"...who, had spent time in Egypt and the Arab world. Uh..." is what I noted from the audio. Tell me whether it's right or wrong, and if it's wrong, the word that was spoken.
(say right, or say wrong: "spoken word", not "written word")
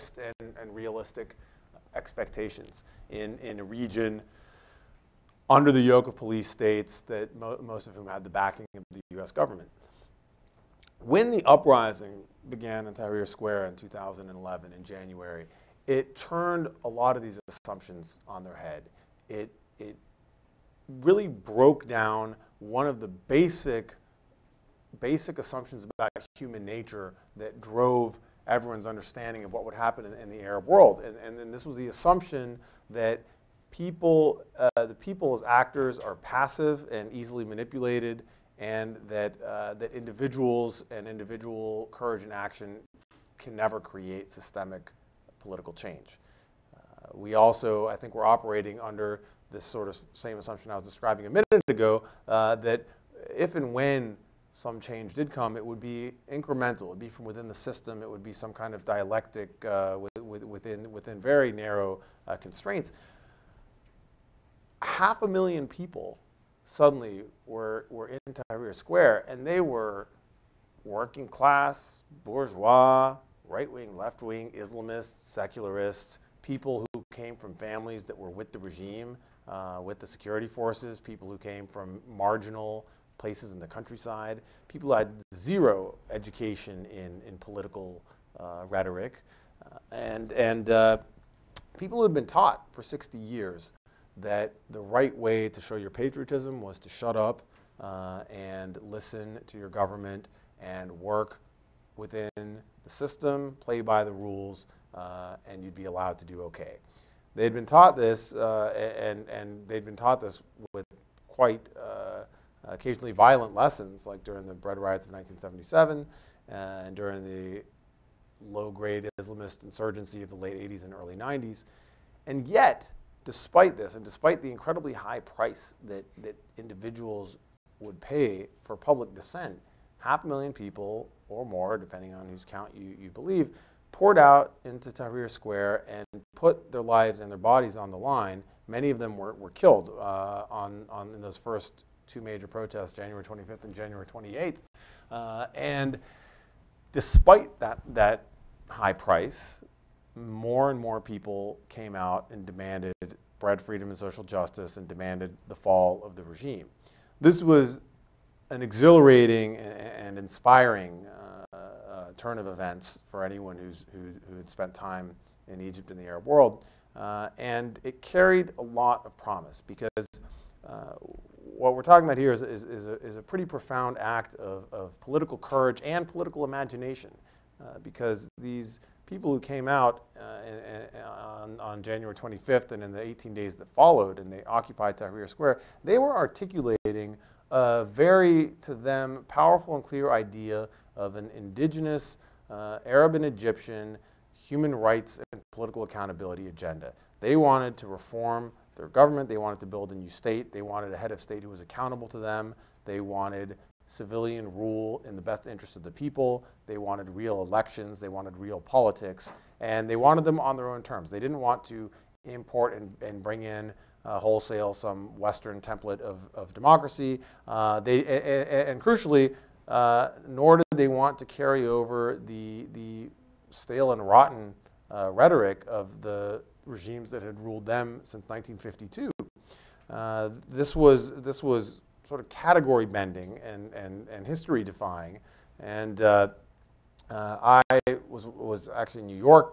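right.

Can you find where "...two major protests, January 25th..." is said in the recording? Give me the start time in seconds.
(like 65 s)
142 s.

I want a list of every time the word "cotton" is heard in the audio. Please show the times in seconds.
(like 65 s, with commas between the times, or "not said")
not said.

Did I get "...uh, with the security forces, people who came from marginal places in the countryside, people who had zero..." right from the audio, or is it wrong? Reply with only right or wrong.
right.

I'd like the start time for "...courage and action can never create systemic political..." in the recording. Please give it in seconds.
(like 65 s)
41 s.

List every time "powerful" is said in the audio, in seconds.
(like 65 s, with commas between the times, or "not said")
189 s.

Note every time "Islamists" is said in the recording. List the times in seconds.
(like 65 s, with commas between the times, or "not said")
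74 s, 119 s.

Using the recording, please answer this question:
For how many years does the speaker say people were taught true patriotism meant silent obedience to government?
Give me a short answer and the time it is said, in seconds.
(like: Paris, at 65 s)
60, at 92 s.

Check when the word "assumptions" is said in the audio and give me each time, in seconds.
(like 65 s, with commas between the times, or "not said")
17 s, 25 s, 31 s, 50 s.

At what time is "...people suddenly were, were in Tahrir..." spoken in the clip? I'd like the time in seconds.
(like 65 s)
65 s.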